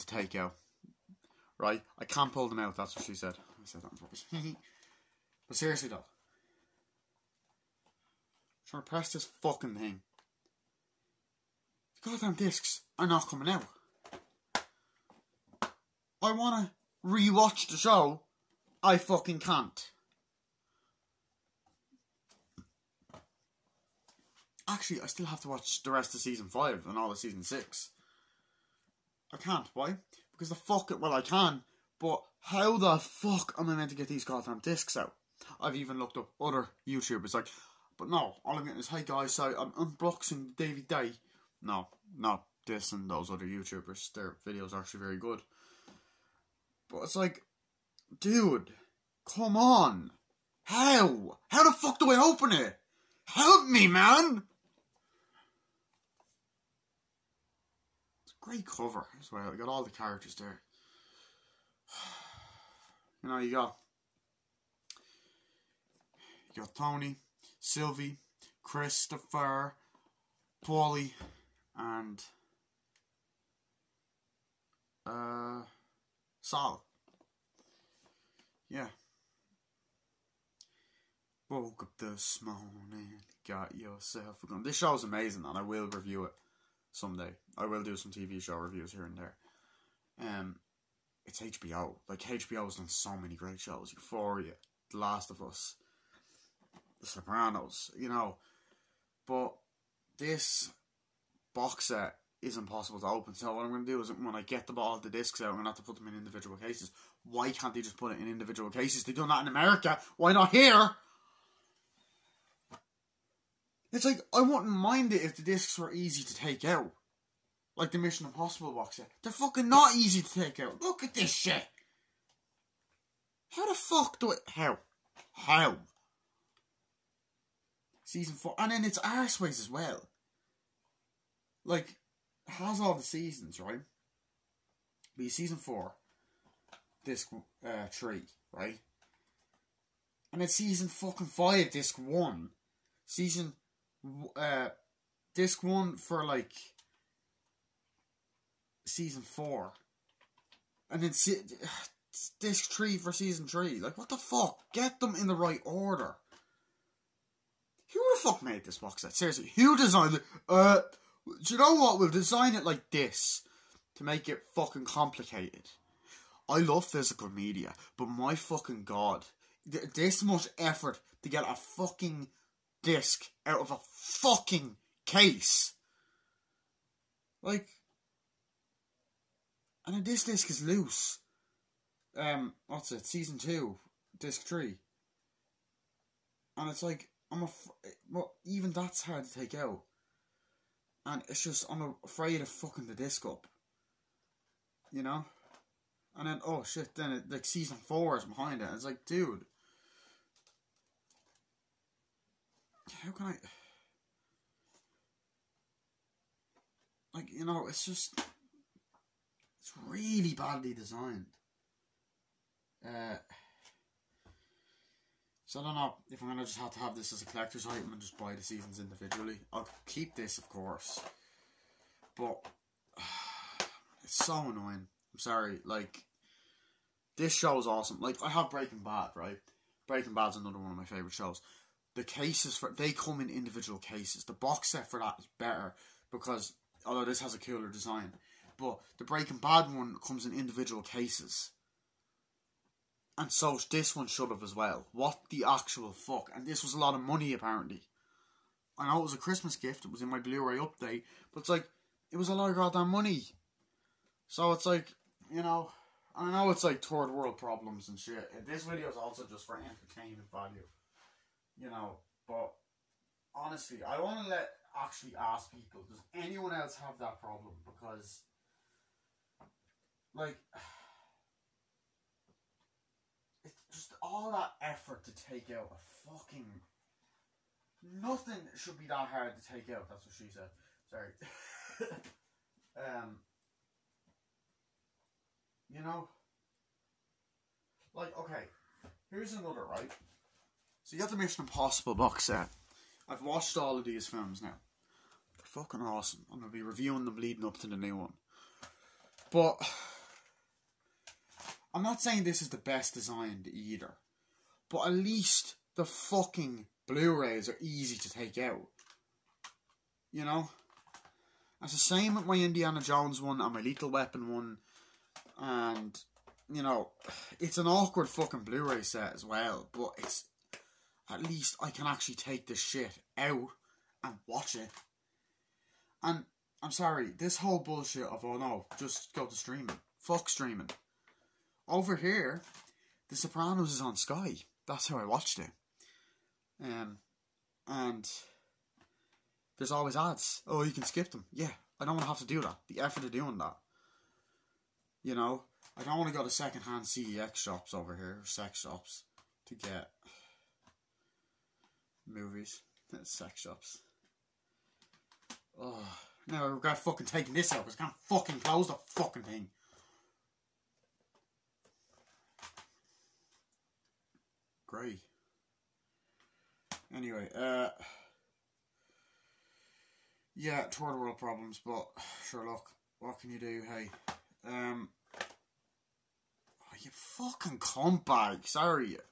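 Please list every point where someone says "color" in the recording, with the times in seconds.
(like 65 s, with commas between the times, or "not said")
not said.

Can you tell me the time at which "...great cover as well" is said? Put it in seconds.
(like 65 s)
58 s.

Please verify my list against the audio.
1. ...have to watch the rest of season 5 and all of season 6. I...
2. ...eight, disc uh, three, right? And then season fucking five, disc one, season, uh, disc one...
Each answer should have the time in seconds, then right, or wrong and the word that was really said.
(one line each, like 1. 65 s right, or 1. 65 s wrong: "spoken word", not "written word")
1. 25 s right
2. 135 s wrong: "four", not "eight".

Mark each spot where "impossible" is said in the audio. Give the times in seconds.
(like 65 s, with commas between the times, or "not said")
102 s, 118 s, 291 s.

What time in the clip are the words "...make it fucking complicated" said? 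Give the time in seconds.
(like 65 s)
164 s.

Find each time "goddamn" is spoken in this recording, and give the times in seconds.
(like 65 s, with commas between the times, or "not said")
12 s, 34 s, 252 s.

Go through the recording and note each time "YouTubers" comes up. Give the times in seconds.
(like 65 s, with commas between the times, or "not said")
36 s, 43 s.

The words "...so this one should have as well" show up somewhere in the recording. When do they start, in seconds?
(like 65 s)
243 s.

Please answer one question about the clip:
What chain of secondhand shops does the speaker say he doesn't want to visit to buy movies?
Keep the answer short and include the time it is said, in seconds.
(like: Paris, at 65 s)
CEX, at 346 s.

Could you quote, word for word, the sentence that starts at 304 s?
But at least the fucking Blu-rays are easy to take out.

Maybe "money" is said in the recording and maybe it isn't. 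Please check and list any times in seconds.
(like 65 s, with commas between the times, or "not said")
247 s, 252 s.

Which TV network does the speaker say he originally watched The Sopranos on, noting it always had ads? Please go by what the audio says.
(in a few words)
Sky.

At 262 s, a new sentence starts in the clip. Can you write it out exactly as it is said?
But honestly, I want to let actually ask people: Does anyone else have that problem?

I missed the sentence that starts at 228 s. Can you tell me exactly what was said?
Like, I have Breaking Bad, right?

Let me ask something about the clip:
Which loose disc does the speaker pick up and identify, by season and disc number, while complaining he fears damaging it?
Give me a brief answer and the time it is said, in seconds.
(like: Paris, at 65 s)
Season 2, disc 3, at 183 s.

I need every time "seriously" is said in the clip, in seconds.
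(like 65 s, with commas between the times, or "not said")
5 s, 159 s.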